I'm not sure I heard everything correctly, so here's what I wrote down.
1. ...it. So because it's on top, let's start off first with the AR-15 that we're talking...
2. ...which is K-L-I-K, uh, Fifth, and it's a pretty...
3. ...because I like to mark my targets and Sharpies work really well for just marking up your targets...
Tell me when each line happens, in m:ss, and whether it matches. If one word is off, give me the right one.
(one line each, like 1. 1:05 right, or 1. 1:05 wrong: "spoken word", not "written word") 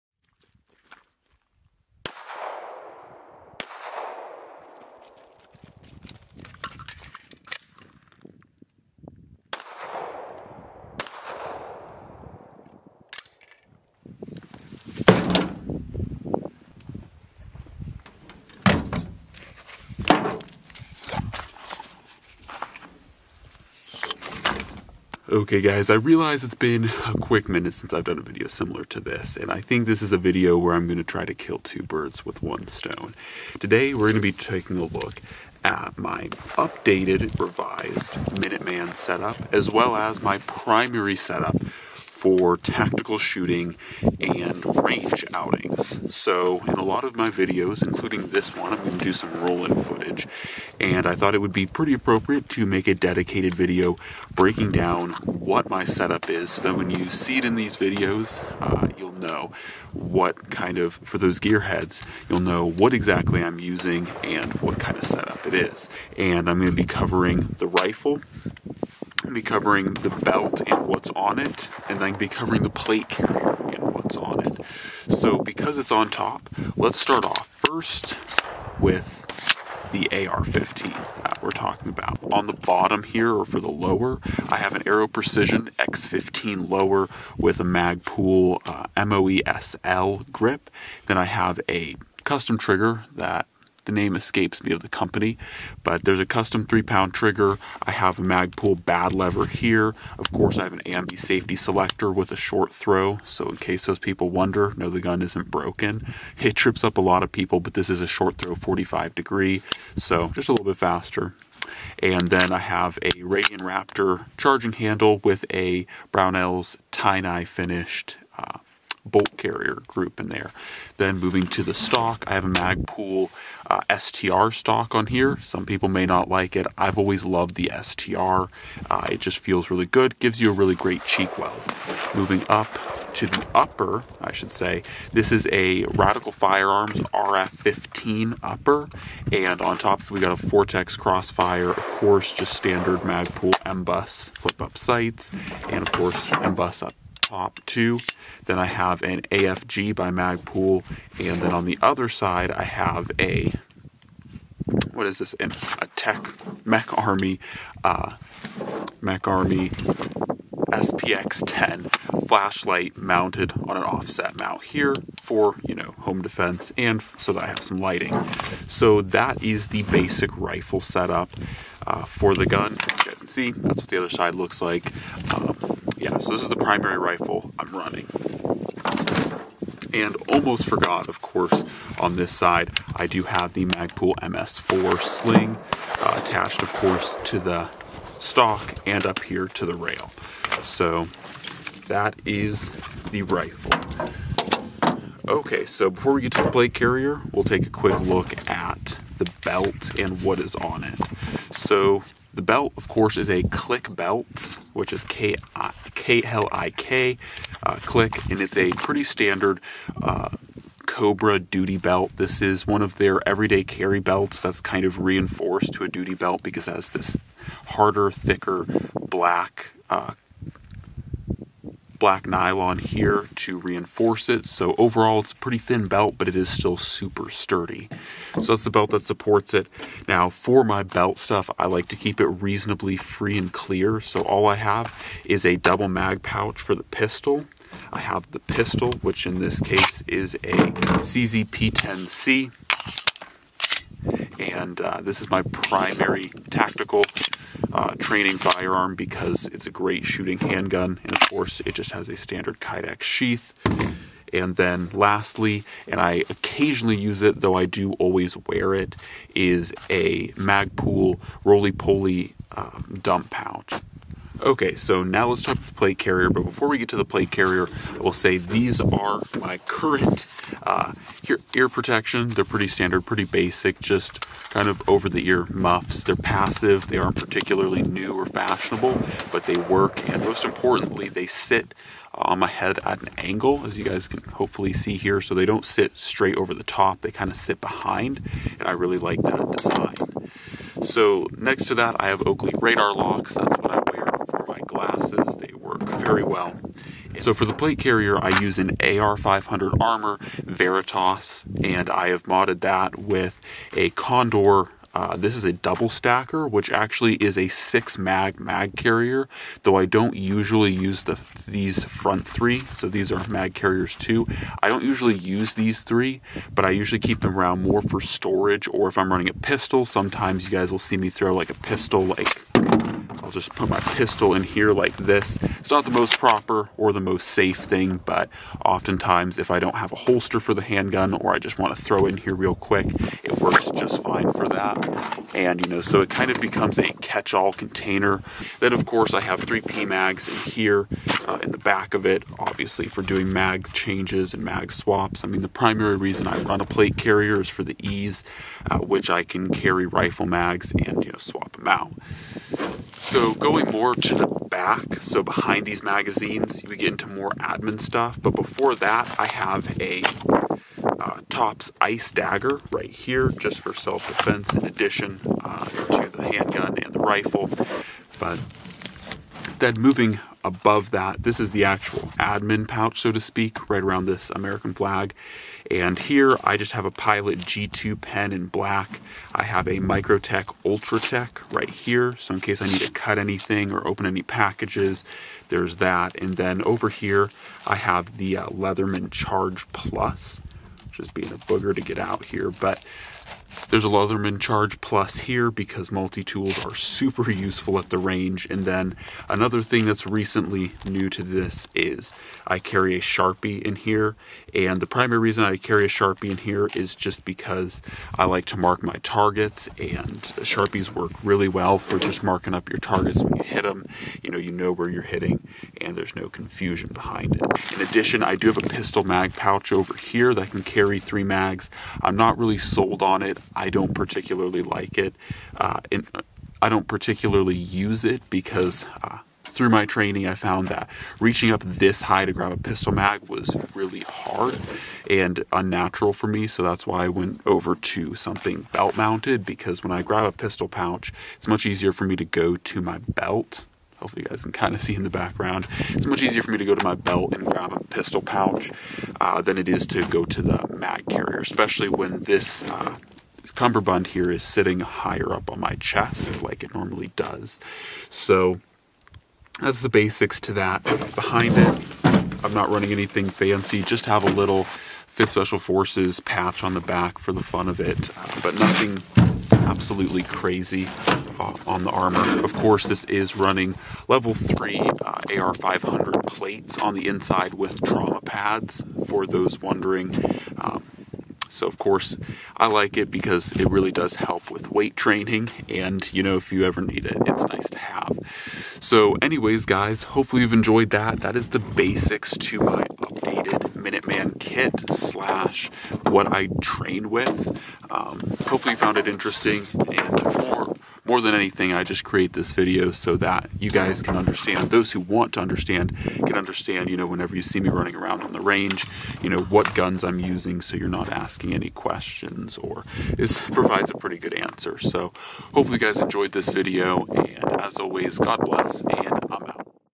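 1. 1:14 right
2. 3:24 wrong: "Klik", not "Fifth"
3. 6:47 right.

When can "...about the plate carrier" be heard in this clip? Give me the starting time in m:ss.
4:25.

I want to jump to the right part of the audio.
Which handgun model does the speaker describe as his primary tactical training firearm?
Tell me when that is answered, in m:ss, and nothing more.
4:01.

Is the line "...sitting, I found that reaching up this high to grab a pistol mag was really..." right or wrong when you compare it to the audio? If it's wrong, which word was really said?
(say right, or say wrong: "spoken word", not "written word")
wrong: "training", not "sitting".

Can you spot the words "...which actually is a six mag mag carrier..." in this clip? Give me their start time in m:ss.
5:06.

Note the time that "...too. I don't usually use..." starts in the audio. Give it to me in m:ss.
5:13.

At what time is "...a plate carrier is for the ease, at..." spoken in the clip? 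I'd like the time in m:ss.
5:46.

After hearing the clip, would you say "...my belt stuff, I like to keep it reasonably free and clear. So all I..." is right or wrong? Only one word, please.
right.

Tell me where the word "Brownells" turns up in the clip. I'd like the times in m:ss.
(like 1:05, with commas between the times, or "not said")
1:56.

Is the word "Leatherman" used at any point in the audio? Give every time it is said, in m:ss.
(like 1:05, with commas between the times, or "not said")
6:28, 6:33.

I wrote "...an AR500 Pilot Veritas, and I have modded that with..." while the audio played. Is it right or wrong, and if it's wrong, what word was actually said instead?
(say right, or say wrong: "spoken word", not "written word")
wrong: "Armor", not "Pilot".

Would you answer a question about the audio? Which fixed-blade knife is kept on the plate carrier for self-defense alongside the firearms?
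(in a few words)
Tops Ice Dagger.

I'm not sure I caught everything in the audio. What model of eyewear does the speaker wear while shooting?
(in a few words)
Oakley Radar Locks.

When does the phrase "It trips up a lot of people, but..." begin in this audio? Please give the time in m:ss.
1:46.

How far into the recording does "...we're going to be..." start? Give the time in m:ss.
0:33.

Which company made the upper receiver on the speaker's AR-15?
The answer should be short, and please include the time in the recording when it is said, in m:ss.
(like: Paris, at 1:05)
Radical Firearms, at 2:15.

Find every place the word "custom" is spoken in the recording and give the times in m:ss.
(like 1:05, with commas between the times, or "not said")
1:32, 1:36.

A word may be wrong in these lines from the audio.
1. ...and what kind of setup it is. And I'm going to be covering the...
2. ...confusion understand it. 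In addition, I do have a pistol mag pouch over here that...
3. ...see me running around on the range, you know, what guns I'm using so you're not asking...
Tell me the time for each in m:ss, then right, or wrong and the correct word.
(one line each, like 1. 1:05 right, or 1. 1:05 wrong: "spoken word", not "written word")
1. 1:04 right
2. 6:56 wrong: "behind", not "understand"
3. 8:27 right.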